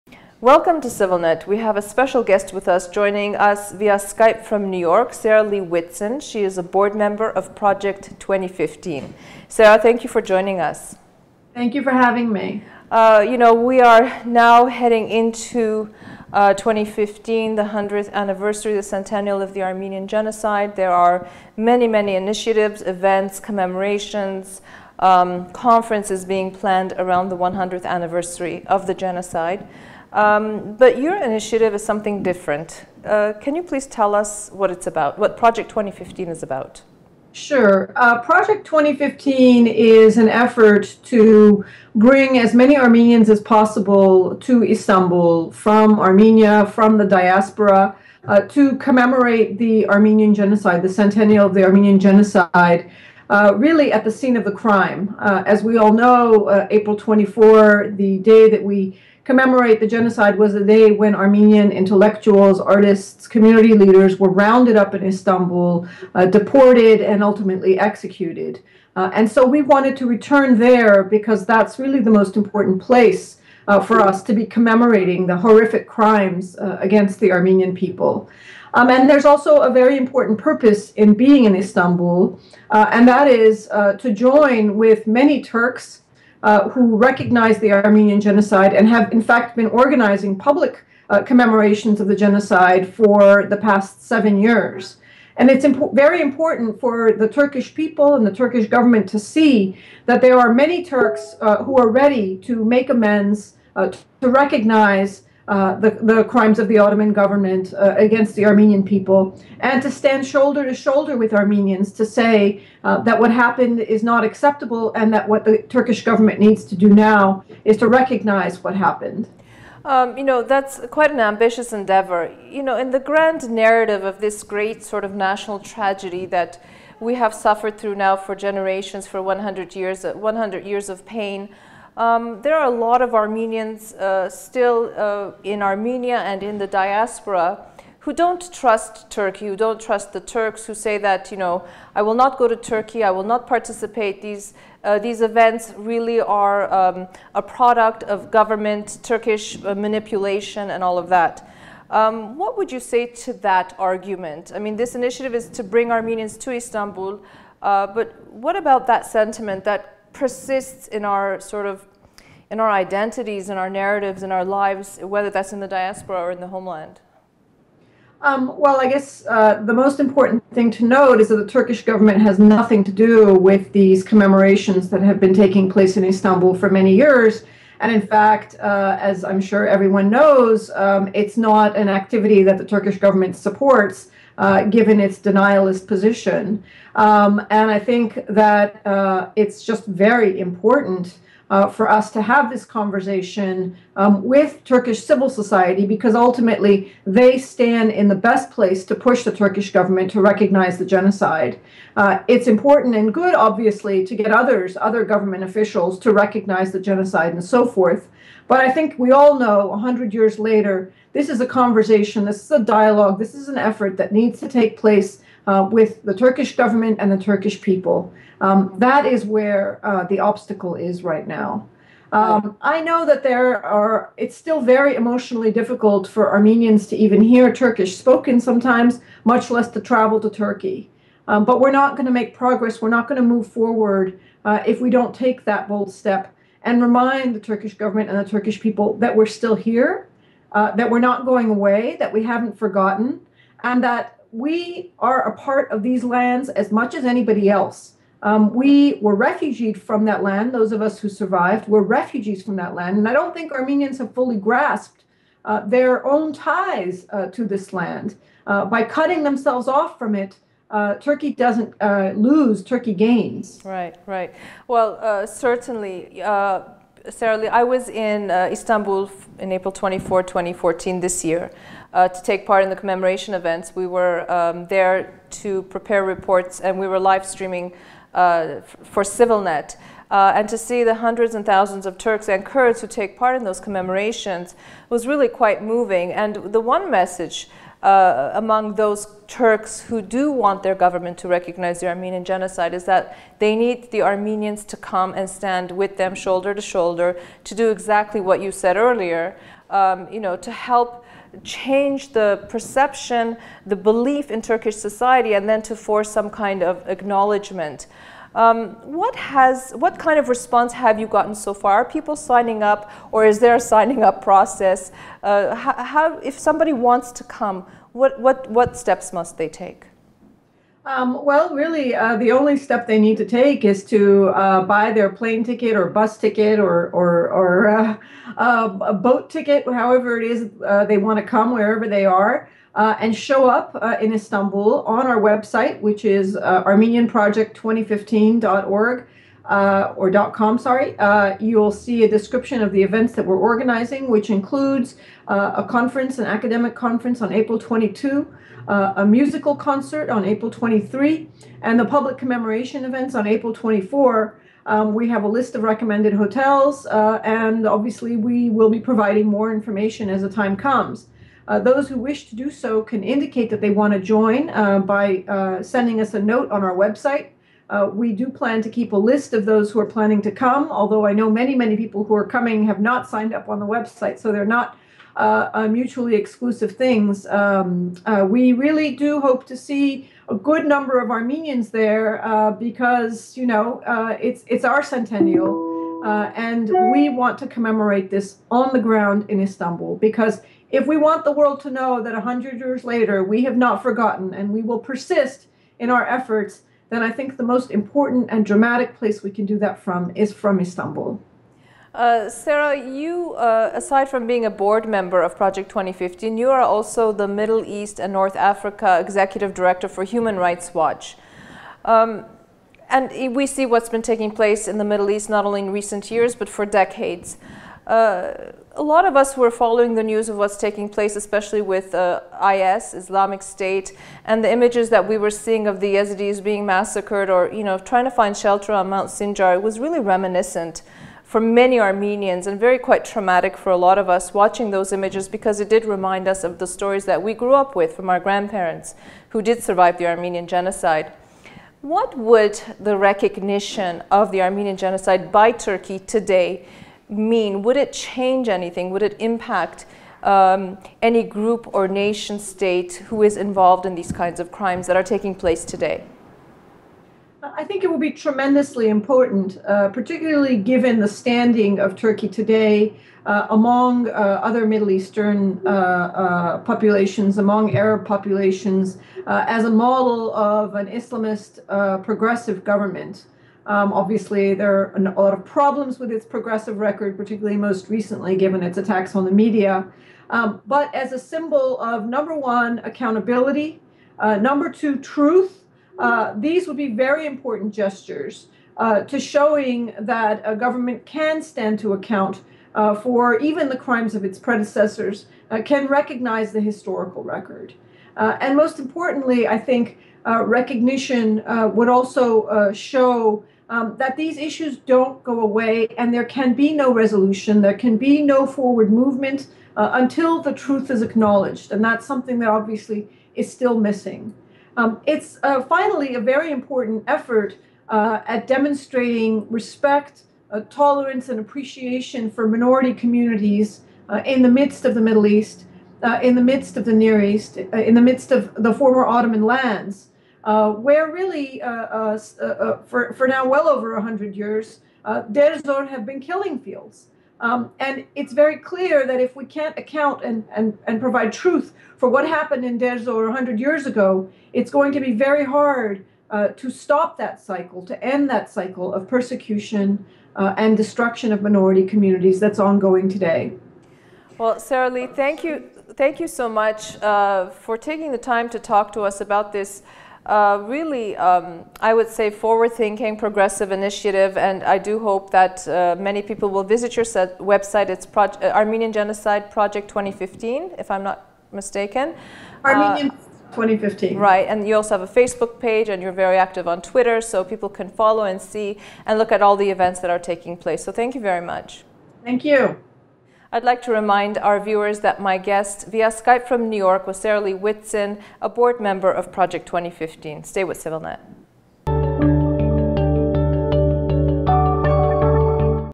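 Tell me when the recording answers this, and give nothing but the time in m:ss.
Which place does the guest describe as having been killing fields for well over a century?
9:02.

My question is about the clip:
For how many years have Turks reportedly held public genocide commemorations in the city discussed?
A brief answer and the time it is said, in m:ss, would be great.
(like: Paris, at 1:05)
7, at 1:34.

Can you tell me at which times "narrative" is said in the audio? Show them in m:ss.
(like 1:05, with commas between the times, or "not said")
2:03, 2:43.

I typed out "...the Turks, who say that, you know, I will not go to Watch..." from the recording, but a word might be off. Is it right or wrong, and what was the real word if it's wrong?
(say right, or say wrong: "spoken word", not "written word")
wrong: "Turkey", not "Watch".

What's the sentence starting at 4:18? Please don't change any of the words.
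Uh, by cutting themselves off from it, uh, Turkey doesn't uh, lose, Turkey gains.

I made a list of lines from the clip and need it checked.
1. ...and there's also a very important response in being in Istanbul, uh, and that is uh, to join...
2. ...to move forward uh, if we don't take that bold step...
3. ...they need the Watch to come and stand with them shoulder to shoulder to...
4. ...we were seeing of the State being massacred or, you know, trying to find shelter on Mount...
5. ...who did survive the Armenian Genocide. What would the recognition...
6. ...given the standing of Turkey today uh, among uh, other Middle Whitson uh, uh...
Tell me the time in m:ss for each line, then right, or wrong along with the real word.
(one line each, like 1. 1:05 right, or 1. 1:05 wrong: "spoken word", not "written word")
1. 1:18 wrong: "purpose", not "response"
2. 3:53 right
3. 4:53 wrong: "Armenians", not "Watch"
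4. 7:05 wrong: "Yazidis", not "State"
5. 7:19 right
6. 7:40 wrong: "Eastern", not "Whitson".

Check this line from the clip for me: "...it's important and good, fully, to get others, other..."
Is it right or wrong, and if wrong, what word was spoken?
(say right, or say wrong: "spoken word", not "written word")
wrong: "obviously", not "fully".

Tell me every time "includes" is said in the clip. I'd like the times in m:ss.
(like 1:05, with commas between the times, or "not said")
5:44.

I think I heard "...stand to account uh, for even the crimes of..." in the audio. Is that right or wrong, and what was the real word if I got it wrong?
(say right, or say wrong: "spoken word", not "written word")
right.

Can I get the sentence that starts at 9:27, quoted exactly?
It's uh, Armenian Genocide Project 2015, if I'm not mistaken.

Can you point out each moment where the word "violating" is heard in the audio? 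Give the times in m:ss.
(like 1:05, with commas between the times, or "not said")
not said.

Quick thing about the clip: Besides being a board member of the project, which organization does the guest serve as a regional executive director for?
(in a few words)
Human Rights Watch.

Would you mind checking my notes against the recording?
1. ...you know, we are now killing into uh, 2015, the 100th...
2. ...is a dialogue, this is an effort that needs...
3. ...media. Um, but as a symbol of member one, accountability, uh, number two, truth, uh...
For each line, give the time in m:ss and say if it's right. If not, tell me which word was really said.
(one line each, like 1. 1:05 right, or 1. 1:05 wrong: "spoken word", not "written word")
1. 0:13 wrong: "heading", not "killing"
2. 3:32 right
3. 7:59 wrong: "number", not "member".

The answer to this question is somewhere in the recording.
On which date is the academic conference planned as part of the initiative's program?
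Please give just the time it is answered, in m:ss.
5:47.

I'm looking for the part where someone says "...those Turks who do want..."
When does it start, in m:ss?
4:48.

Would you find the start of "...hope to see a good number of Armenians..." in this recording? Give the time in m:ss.
6:19.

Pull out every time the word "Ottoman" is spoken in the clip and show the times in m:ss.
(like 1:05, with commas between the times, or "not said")
1:46, 8:49.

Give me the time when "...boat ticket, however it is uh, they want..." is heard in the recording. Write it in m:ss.
5:28.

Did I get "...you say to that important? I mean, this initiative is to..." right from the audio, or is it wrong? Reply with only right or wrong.
wrong.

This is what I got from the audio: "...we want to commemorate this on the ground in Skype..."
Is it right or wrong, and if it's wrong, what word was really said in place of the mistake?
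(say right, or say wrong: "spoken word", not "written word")
wrong: "Istanbul", not "Skype".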